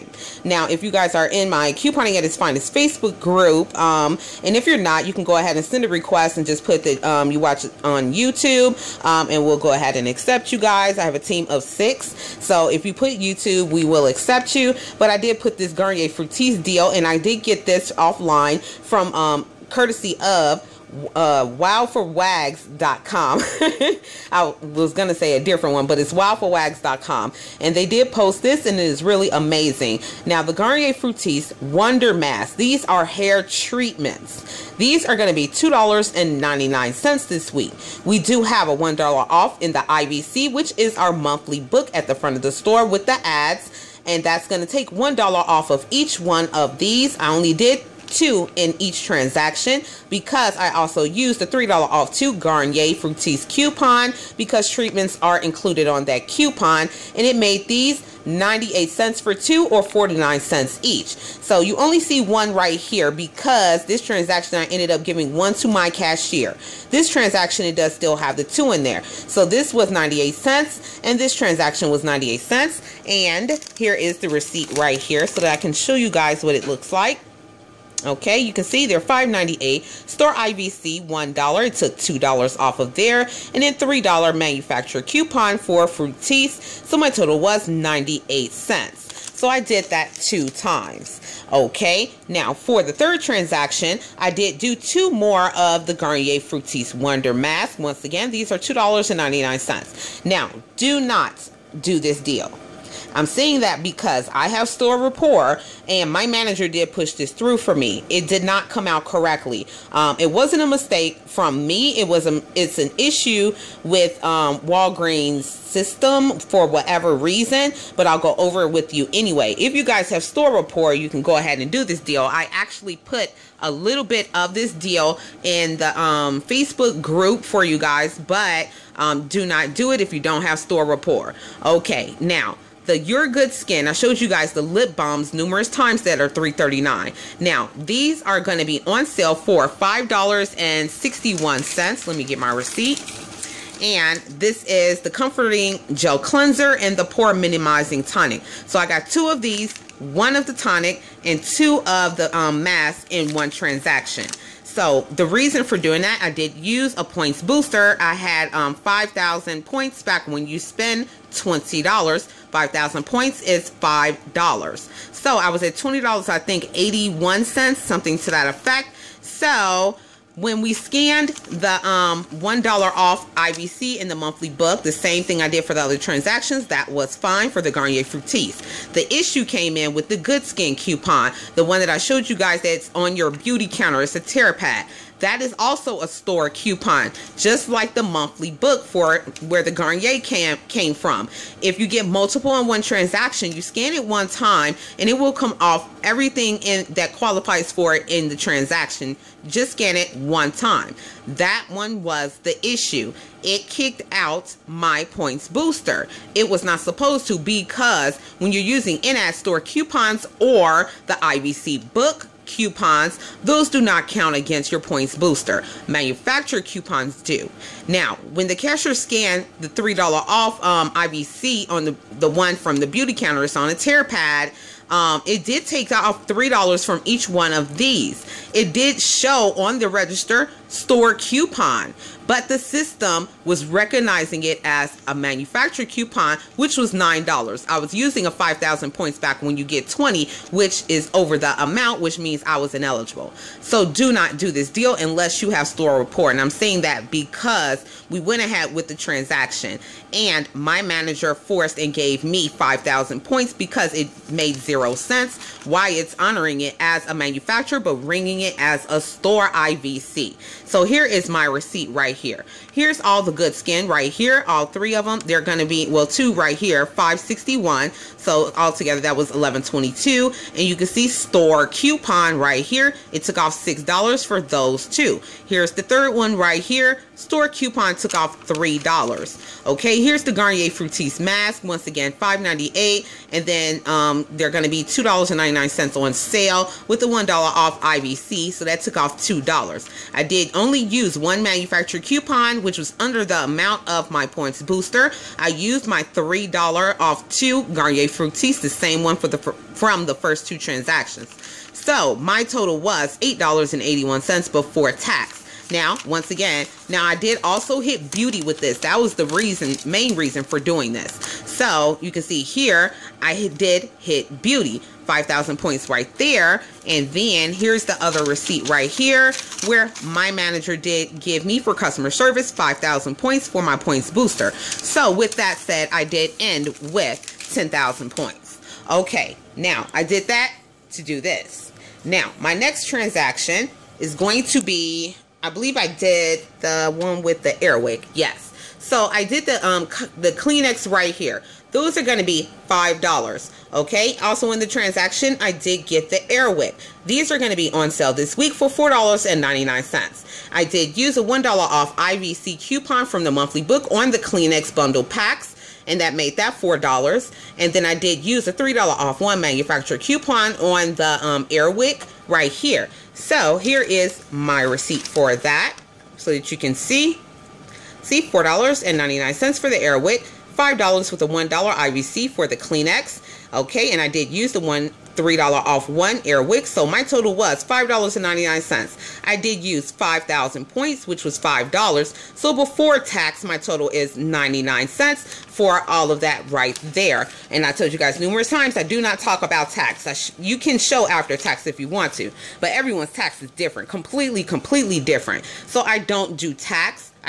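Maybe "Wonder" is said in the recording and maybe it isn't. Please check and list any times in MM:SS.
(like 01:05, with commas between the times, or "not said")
00:31, 01:36.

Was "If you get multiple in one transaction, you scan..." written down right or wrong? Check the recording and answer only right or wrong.
right.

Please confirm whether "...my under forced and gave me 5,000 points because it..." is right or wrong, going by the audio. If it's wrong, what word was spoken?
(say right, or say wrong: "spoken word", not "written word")
wrong: "manager", not "under".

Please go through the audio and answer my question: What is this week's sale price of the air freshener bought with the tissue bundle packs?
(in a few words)
$4.99.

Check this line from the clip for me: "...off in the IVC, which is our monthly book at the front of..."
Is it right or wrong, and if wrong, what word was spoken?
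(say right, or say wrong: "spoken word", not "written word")
right.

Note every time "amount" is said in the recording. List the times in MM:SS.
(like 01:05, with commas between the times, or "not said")
04:01, 04:53.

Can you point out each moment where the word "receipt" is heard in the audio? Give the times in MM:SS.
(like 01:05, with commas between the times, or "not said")
01:14, 02:22, 04:21, 05:18, 06:04.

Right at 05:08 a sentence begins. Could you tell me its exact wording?
That was the reason, main reason for doing this.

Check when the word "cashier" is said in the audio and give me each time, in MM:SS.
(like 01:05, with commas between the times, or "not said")
01:05, 03:38.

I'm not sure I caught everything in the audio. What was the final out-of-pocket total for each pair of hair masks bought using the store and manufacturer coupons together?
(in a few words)
98 cents.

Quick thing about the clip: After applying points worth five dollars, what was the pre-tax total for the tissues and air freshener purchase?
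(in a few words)
99 cents.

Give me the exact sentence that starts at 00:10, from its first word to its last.
I have a team of six, so if you put YouTube, we will accept you.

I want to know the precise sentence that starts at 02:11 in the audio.
Okay, now the Your Good Skin.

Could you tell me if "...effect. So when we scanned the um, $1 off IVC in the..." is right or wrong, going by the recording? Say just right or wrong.
right.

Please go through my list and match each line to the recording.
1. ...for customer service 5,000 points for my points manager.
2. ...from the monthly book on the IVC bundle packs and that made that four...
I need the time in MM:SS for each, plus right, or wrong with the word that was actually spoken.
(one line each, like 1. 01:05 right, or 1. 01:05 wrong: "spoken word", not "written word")
1. 05:21 wrong: "booster", not "manager"
2. 05:53 wrong: "Kleenex", not "IVC".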